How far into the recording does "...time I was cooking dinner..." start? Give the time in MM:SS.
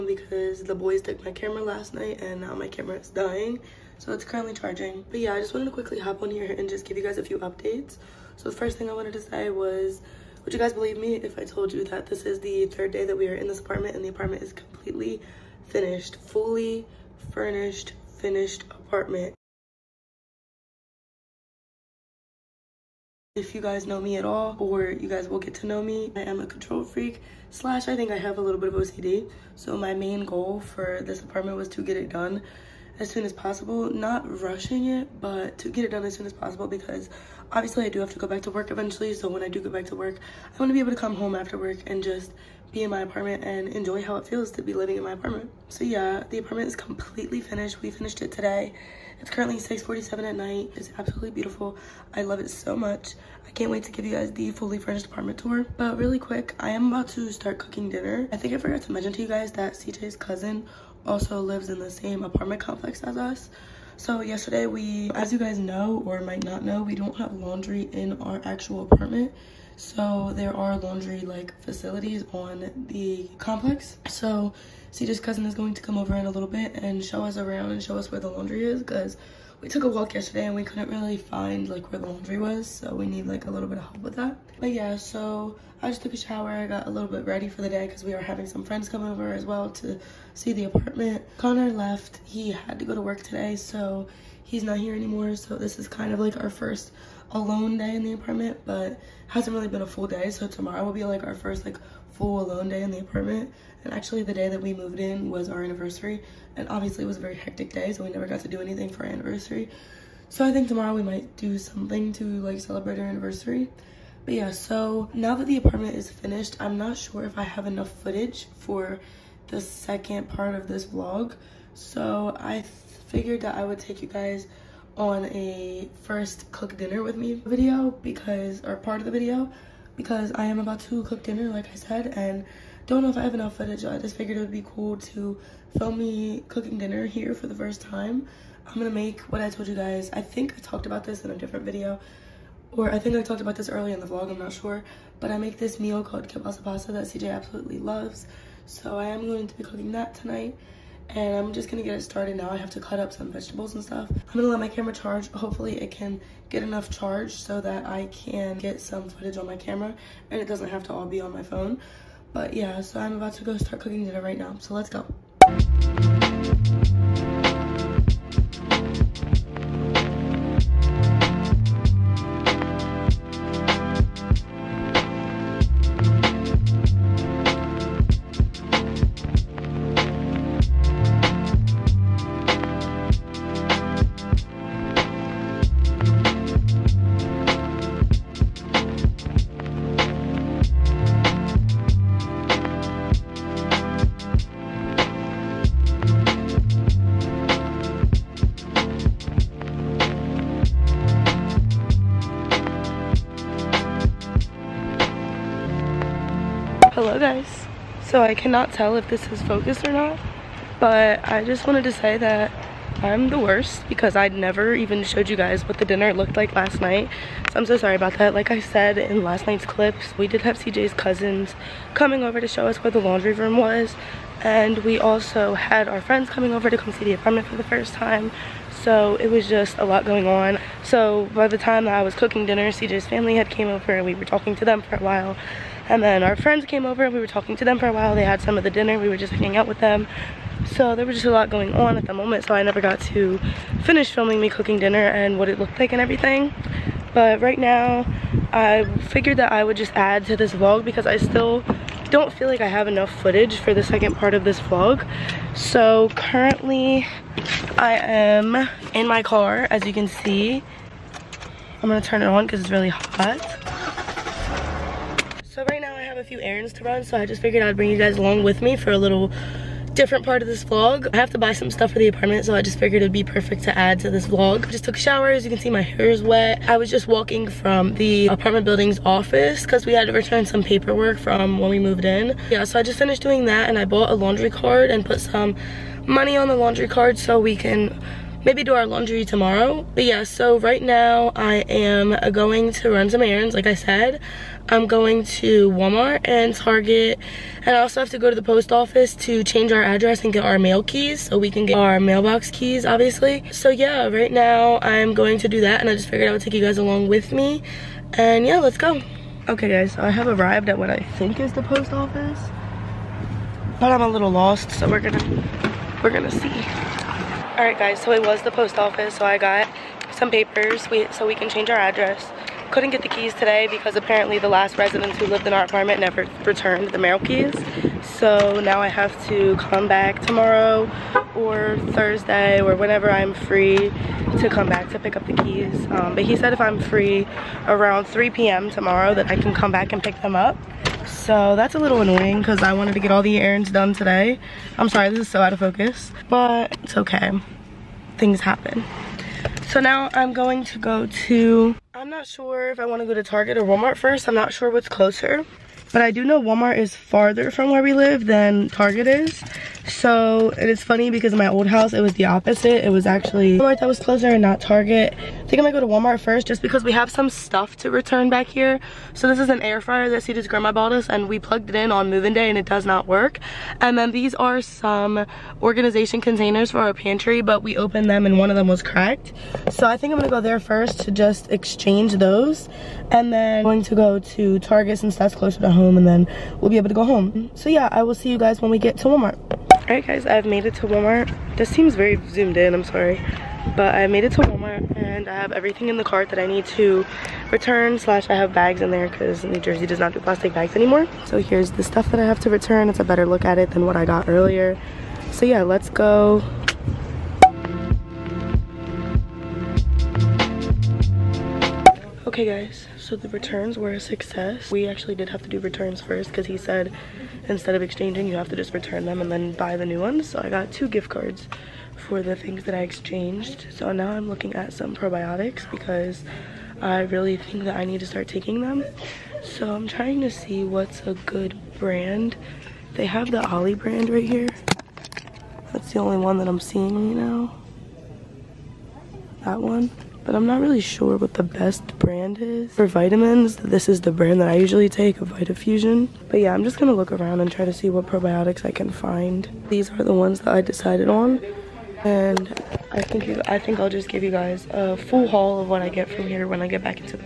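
03:51.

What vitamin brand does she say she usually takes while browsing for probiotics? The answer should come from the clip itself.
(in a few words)
VitaFusion.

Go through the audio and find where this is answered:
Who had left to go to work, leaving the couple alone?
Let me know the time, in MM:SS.
01:31.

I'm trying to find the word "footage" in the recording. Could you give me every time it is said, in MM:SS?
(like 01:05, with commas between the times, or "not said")
01:58, 02:13, 02:39, 04:13.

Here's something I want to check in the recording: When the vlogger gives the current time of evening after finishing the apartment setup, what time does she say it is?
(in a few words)
6:47.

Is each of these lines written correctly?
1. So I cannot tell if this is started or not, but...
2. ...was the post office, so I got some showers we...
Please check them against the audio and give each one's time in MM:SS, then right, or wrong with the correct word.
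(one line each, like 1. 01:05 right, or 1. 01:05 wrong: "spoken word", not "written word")
1. 03:28 wrong: "focused", not "started"
2. 05:18 wrong: "papers", not "showers".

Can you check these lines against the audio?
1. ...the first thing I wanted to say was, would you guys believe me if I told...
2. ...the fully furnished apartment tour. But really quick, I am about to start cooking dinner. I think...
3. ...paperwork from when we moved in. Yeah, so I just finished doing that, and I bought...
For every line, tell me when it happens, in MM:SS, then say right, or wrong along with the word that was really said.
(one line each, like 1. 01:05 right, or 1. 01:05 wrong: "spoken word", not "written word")
1. 00:08 right
2. 00:54 right
3. 04:40 right.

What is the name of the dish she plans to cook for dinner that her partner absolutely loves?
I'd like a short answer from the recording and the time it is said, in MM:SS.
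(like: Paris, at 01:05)
Kielbasa pasta, at 02:26.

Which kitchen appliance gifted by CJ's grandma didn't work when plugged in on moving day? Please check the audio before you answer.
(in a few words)
Air fryer.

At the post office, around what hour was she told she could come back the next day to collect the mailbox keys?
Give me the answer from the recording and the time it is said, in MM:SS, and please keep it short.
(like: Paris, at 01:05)
3 p.m., at 05:38.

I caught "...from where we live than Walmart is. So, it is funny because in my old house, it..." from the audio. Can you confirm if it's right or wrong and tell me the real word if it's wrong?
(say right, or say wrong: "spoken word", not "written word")
wrong: "Target", not "Walmart".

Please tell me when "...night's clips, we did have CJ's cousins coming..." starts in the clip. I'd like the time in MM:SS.
03:39.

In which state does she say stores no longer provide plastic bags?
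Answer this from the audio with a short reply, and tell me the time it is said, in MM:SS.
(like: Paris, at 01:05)
New Jersey, at 06:39.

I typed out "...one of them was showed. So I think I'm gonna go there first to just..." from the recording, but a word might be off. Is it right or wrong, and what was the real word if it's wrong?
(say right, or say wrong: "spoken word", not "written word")
wrong: "cracked", not "showed".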